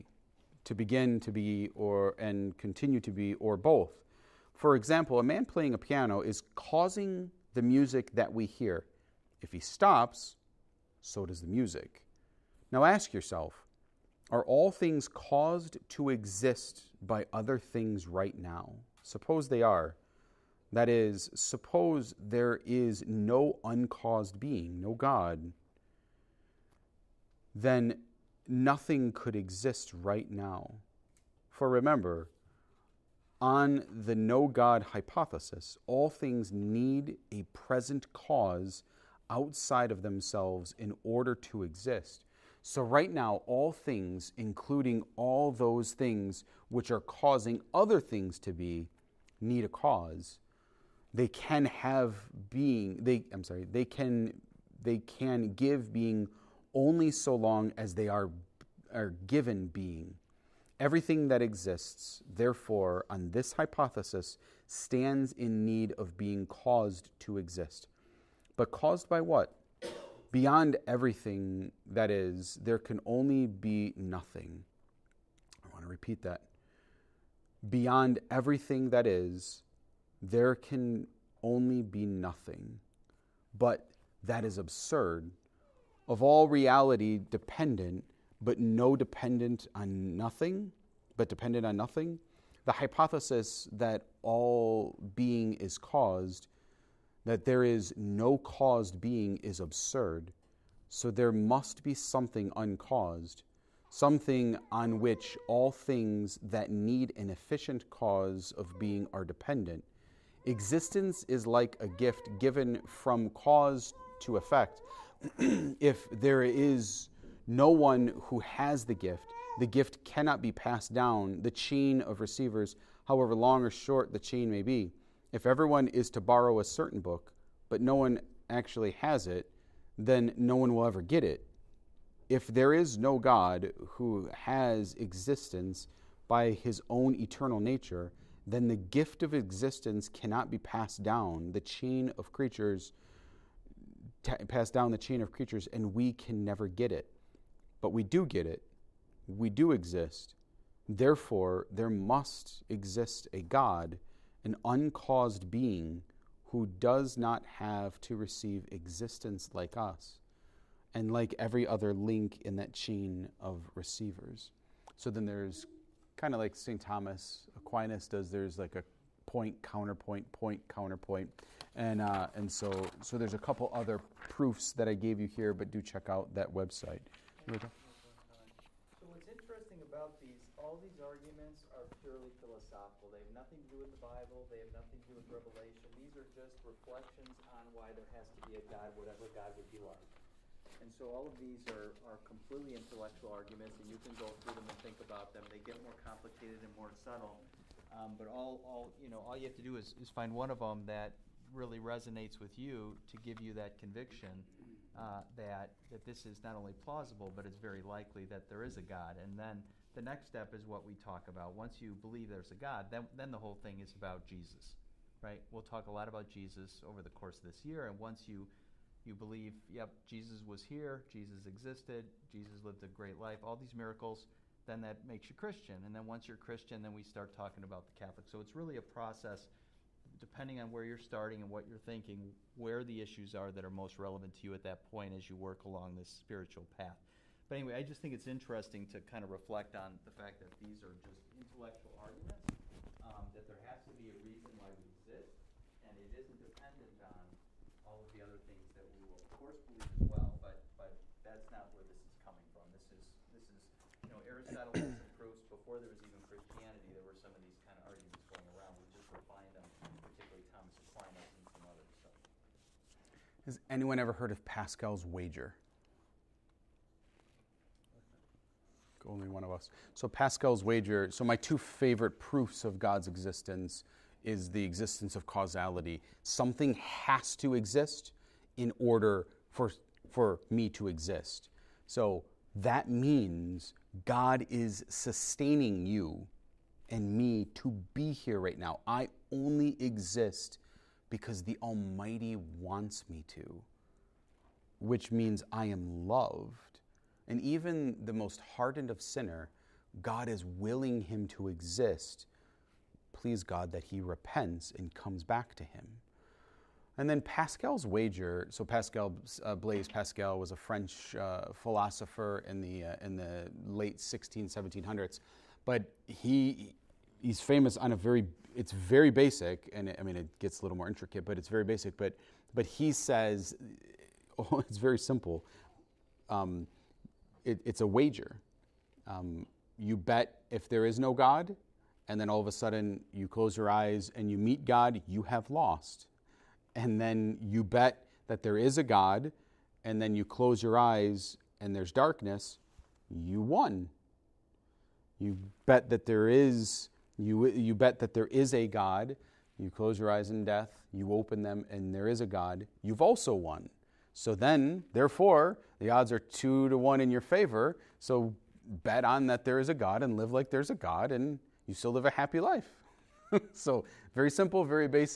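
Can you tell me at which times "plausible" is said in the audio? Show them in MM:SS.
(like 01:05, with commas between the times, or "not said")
03:26.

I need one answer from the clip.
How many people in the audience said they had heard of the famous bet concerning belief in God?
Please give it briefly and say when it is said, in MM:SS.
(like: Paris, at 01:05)
1, at 04:29.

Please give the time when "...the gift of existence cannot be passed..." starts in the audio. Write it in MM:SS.
02:18.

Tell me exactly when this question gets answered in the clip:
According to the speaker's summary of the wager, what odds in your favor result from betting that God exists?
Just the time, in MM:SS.
05:56.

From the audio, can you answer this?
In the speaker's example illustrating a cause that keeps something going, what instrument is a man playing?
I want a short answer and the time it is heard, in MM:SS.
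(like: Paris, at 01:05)
piano, at 00:05.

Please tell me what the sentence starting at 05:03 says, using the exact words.
Please God that he repents and comes back to him.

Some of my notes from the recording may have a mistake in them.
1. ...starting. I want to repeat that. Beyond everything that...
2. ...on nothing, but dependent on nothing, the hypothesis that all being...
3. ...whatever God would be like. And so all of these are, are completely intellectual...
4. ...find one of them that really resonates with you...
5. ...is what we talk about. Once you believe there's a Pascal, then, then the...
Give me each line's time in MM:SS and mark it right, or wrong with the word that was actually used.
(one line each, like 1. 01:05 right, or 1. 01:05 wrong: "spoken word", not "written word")
1. 01:13 wrong: "nothing", not "starting"
2. 01:29 right
3. 03:08 right
4. 03:20 right
5. 03:30 wrong: "God", not "Pascal".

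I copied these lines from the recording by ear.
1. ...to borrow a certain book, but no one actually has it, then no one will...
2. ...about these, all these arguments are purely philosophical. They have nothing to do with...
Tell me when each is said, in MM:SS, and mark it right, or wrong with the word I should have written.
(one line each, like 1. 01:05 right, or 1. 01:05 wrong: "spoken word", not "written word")
1. 02:06 right
2. 02:59 right.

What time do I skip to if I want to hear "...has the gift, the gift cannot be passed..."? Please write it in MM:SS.
01:58.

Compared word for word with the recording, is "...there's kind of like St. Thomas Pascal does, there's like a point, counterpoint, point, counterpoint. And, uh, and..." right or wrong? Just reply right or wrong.
wrong.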